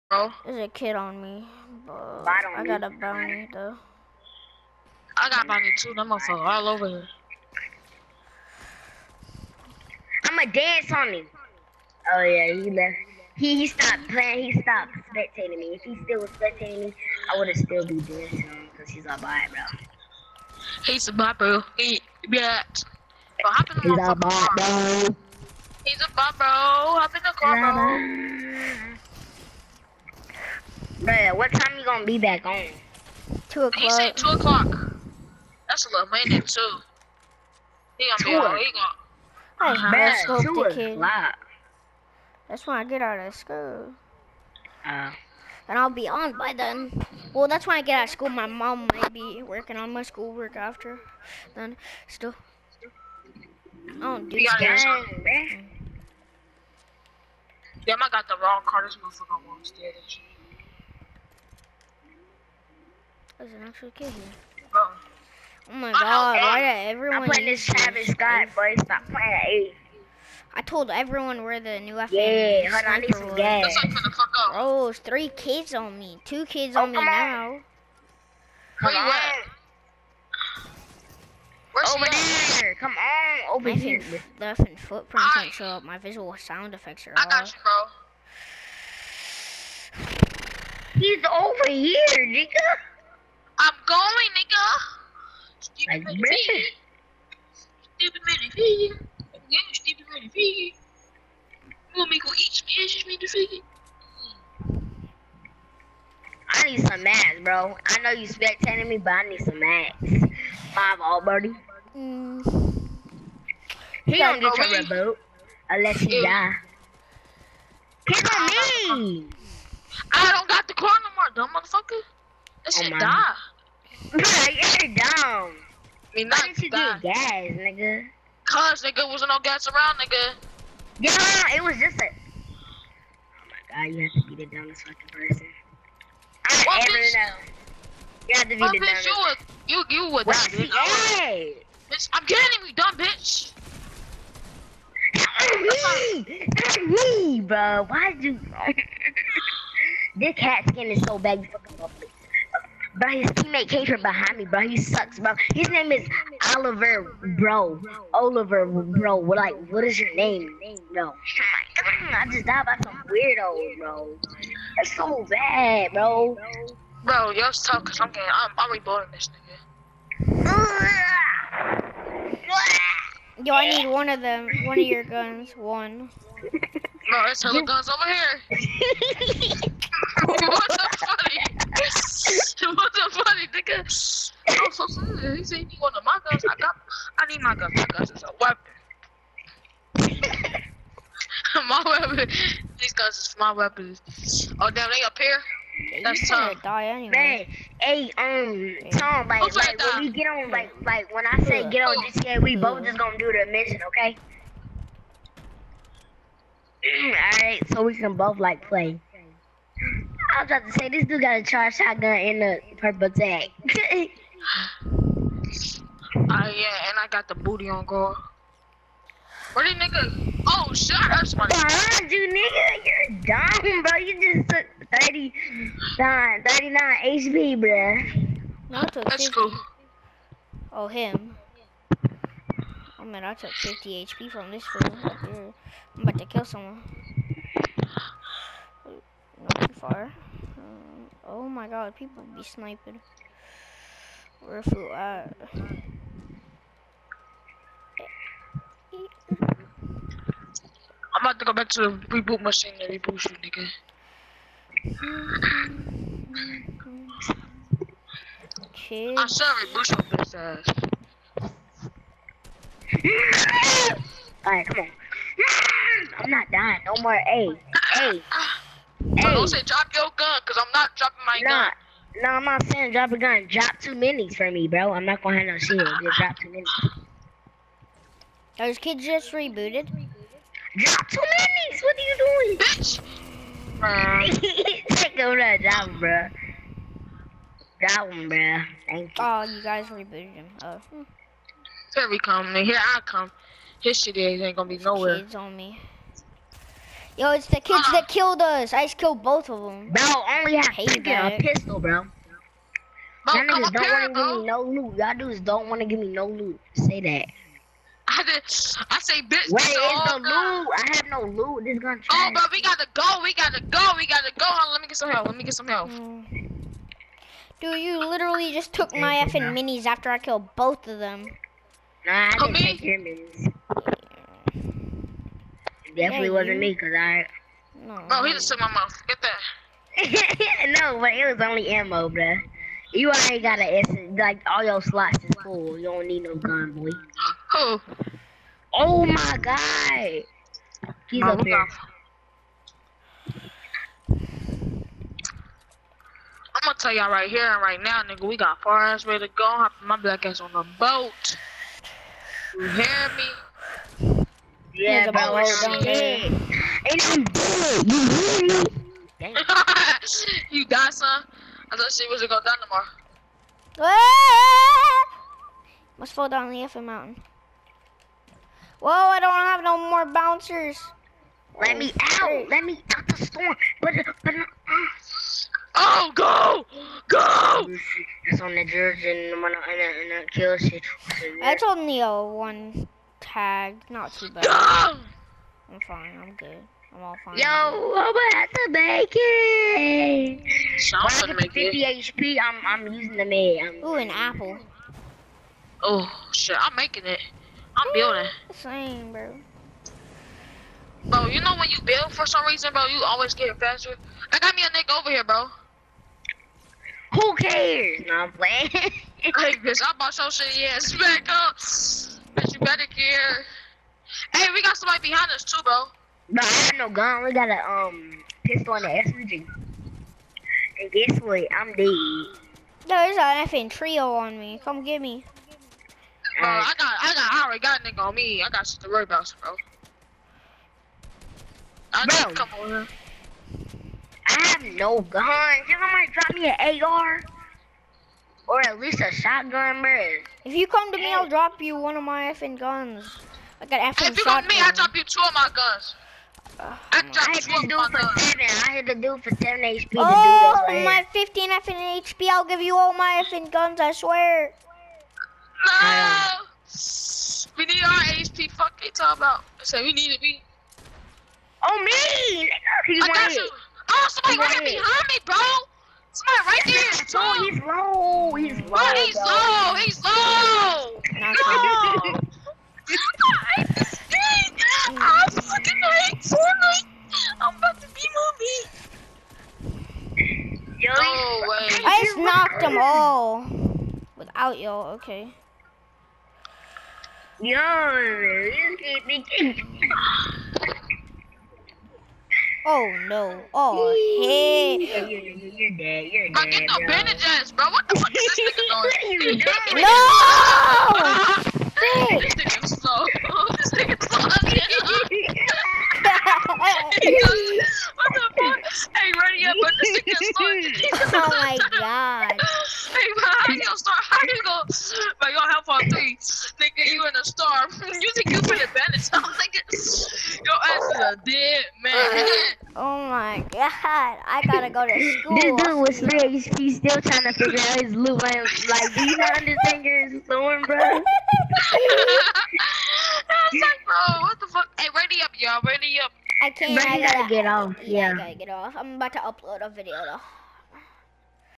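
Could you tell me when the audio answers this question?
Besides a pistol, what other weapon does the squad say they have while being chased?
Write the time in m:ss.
6:59.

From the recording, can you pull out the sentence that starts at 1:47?
I know you spectating me, but I need some mats.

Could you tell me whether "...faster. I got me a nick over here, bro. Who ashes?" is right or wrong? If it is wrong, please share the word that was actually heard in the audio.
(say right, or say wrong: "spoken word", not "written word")
wrong: "cares", not "ashes".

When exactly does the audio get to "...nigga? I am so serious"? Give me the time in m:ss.
3:03.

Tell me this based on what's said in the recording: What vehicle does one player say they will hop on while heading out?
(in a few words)
boat.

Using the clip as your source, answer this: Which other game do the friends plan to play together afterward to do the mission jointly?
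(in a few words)
GTA.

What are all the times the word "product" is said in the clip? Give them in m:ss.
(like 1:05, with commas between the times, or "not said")
not said.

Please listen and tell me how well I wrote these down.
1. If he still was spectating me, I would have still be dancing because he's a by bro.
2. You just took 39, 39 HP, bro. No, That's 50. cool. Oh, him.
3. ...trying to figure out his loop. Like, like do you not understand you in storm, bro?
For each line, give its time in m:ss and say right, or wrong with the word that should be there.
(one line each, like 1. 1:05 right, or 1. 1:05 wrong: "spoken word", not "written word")
1. 0:15 right
2. 3:43 right
3. 8:47 right.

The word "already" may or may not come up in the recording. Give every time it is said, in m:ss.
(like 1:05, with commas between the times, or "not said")
5:33, 7:07.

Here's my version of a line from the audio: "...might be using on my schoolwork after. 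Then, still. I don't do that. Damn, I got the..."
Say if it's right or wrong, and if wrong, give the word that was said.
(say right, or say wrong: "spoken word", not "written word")
wrong: "working", not "using".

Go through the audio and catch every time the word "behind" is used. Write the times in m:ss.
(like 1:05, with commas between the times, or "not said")
2:34, 6:55, 7:44.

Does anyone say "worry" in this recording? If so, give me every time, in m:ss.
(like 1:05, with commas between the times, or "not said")
7:08.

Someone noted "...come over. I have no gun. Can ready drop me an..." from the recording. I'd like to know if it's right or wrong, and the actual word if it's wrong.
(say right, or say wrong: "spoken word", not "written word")
wrong: "somebody", not "ready".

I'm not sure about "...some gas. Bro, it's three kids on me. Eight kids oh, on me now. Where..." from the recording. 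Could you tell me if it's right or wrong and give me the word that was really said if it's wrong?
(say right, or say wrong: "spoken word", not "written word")
wrong: "Two", not "Eight".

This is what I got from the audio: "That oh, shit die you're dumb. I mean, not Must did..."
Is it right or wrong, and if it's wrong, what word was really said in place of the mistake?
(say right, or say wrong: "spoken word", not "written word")
wrong: "Why", not "Must".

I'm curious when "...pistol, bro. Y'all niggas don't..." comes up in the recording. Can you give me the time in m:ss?
5:01.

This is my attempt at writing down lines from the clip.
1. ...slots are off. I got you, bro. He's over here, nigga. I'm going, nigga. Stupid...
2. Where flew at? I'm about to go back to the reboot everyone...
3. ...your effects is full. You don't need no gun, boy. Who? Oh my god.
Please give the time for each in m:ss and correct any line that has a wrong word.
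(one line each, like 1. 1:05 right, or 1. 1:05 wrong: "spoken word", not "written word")
1. 1:26 wrong: "effects", not "slots"
2. 4:04 wrong: "machine", not "everyone"
3. 5:34 wrong: "slots", not "effects".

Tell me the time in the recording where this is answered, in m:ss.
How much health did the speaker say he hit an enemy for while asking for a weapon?
7:29.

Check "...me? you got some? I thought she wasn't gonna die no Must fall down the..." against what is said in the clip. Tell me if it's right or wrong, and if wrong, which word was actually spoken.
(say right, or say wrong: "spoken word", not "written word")
right.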